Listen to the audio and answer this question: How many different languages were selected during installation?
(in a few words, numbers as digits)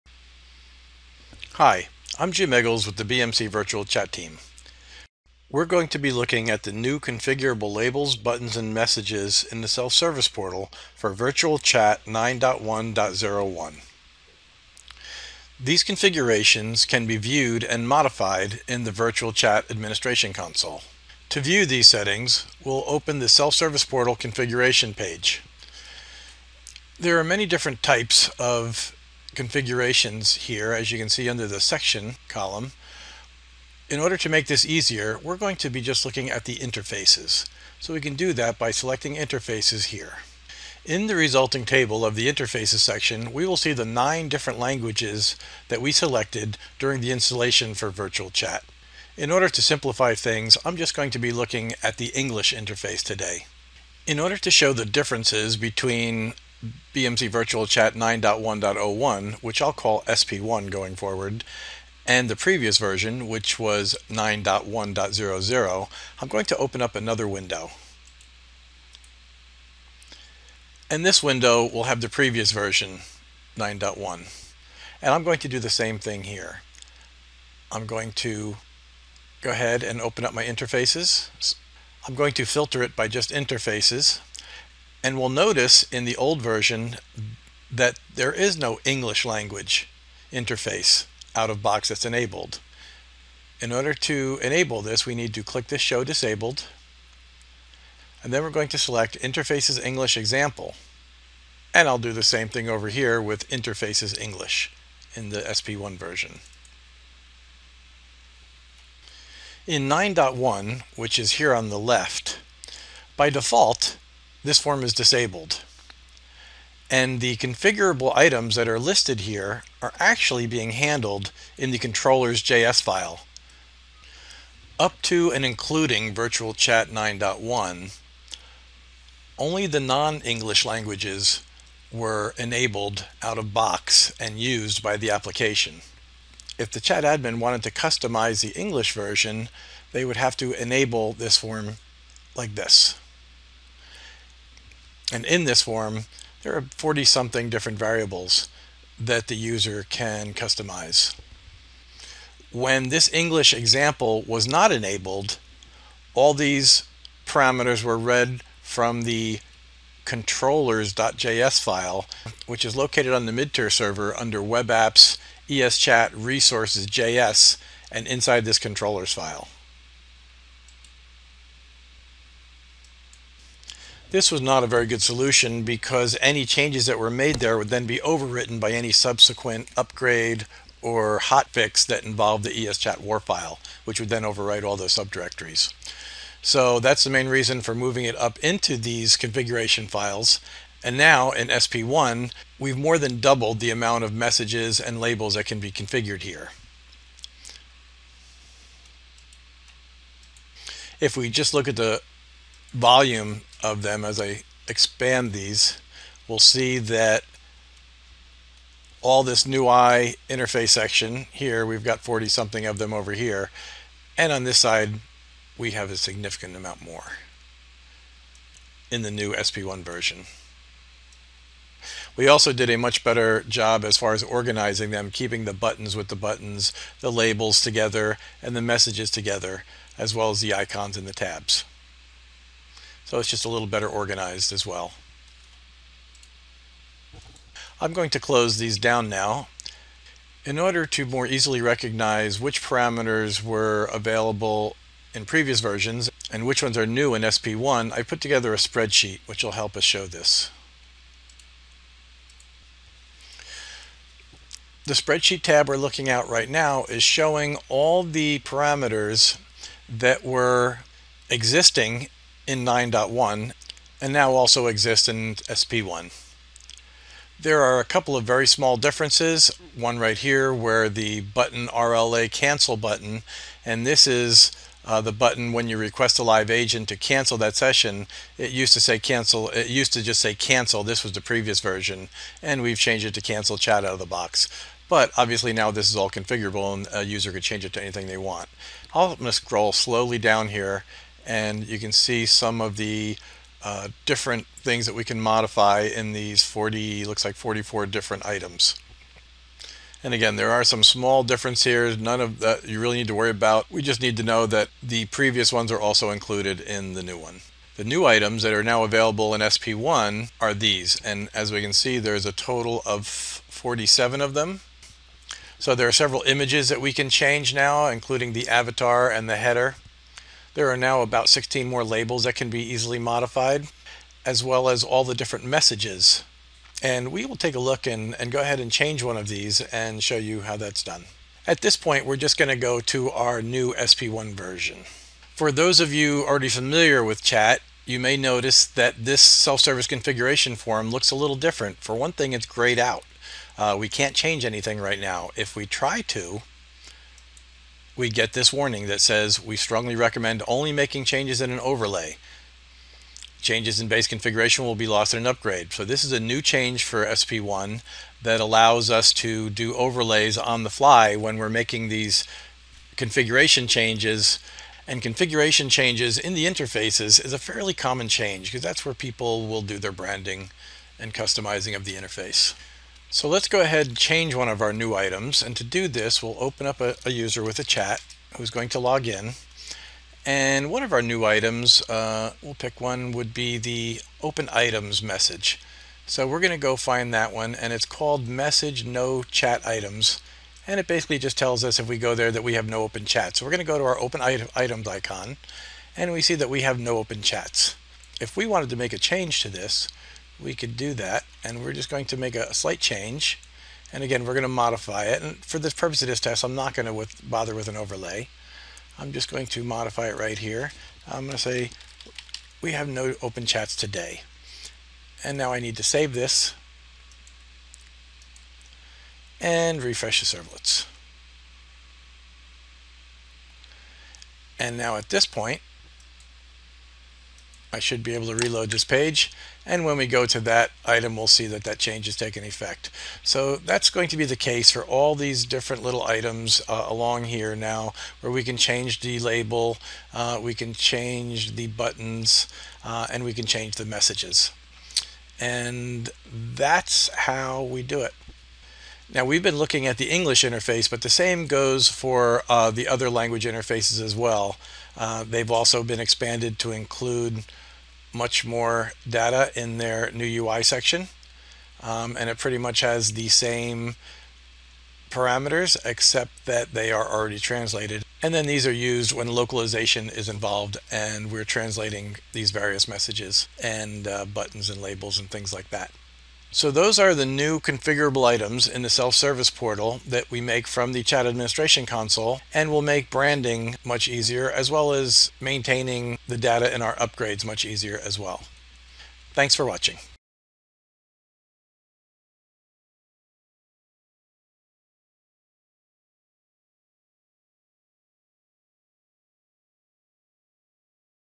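9.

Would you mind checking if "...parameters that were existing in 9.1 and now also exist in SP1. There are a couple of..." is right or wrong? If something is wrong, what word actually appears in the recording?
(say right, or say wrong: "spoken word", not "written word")
right.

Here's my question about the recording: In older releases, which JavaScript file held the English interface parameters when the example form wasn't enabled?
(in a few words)
controllers.js.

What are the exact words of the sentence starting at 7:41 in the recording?
Um, and it pretty much has the same parameters except that they are already translated.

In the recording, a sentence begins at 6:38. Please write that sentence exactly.
If we wanted to make a change to this, we could do that.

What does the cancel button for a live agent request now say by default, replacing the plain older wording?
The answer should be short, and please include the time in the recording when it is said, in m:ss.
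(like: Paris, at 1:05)
Cancel chat, at 4:43.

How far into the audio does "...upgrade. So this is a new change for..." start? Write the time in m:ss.
5:55.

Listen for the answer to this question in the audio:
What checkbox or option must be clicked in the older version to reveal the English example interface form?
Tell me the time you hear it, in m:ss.
1:35.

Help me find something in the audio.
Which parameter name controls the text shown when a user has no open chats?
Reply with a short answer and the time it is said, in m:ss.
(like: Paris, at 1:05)
message no chat items, at 6:28.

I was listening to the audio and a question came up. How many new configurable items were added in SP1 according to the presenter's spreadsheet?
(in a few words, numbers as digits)
47.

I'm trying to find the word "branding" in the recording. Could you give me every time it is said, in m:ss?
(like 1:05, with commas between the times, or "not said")
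6:09, 8:03.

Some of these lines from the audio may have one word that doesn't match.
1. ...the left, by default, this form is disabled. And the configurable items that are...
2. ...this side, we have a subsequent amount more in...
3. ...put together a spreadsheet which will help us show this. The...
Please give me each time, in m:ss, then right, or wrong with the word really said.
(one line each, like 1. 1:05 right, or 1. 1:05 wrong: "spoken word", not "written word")
1. 1:51 right
2. 3:34 wrong: "significant", not "subsequent"
3. 4:08 right.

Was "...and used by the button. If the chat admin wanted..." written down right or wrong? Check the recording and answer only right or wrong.
wrong.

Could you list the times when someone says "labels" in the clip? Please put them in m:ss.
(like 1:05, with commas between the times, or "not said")
0:07, 3:14, 3:47, 5:21, 7:19, 7:54.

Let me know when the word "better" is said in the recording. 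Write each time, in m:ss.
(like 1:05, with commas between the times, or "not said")
3:43, 3:53.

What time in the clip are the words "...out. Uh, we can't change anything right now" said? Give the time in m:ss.
5:42.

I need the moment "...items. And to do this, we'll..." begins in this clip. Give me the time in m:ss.
6:14.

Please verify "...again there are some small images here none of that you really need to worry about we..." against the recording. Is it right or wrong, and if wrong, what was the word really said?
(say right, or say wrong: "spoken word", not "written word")
wrong: "differences", not "images".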